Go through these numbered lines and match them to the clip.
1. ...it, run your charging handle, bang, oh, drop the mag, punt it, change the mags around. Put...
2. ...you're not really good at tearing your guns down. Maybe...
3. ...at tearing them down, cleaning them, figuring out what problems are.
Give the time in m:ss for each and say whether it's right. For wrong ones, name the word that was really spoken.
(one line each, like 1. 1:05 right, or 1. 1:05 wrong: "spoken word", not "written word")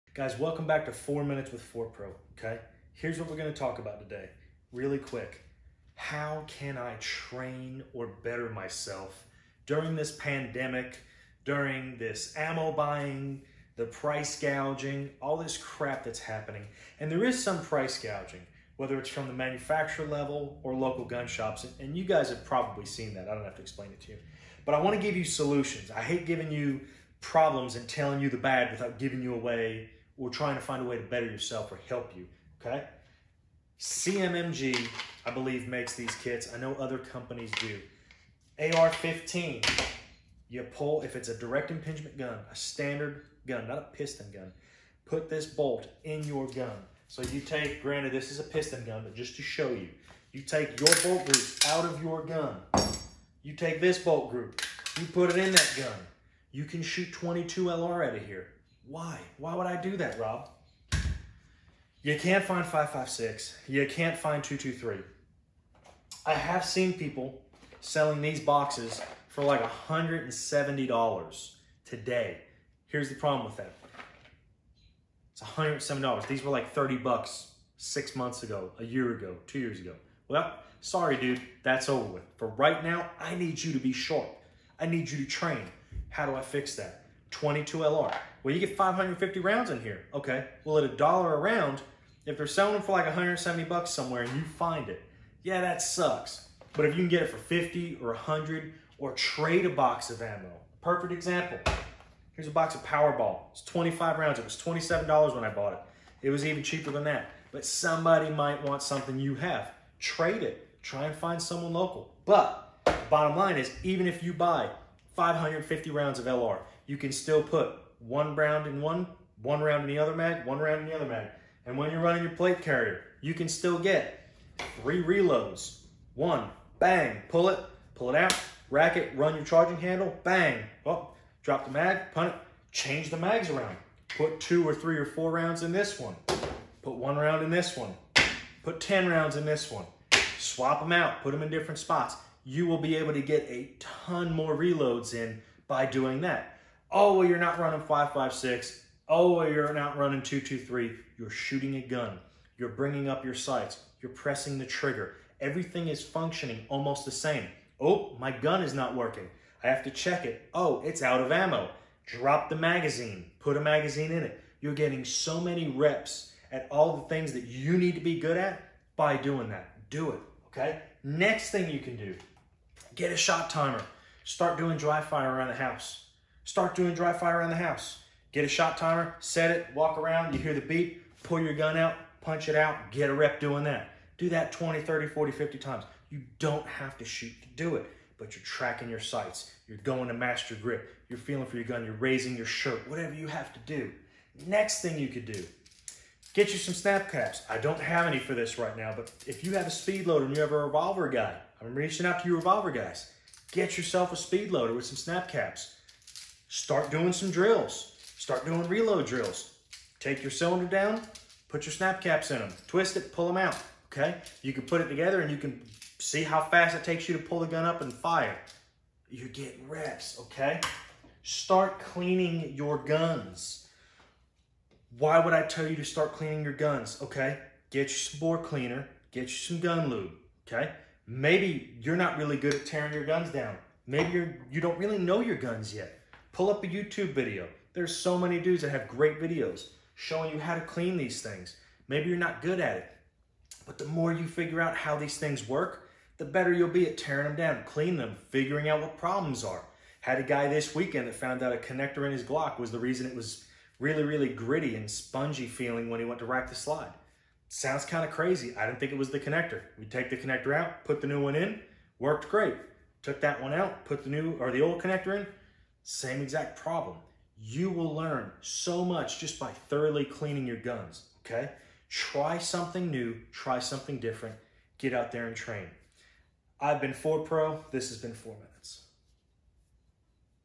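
1. 2:08 right
2. 3:51 right
3. 4:06 right.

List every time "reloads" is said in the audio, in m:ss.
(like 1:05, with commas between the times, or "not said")
2:05, 2:24, 3:28.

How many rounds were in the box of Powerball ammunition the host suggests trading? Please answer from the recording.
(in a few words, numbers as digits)
25.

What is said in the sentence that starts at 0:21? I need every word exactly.
And you guys have probably seen that.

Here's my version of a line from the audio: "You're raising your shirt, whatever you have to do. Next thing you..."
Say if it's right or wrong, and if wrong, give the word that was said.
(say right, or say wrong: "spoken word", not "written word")
right.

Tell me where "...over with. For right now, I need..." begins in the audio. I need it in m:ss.
1:21.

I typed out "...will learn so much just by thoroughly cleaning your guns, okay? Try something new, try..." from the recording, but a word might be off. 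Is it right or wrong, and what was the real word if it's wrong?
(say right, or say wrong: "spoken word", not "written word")
right.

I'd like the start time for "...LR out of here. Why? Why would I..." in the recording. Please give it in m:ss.
0:57.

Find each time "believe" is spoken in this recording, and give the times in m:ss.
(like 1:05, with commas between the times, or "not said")
0:35.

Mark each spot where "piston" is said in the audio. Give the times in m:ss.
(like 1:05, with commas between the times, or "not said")
0:43, 0:48.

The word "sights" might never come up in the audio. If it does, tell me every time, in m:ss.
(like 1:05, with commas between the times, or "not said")
2:33, 3:08.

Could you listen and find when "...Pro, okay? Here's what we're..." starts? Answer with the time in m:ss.
0:01.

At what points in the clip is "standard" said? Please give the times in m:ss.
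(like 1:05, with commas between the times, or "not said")
0:42.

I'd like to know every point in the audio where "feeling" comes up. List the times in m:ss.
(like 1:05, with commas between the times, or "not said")
3:11, 4:15.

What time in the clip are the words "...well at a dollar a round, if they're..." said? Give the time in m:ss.
1:30.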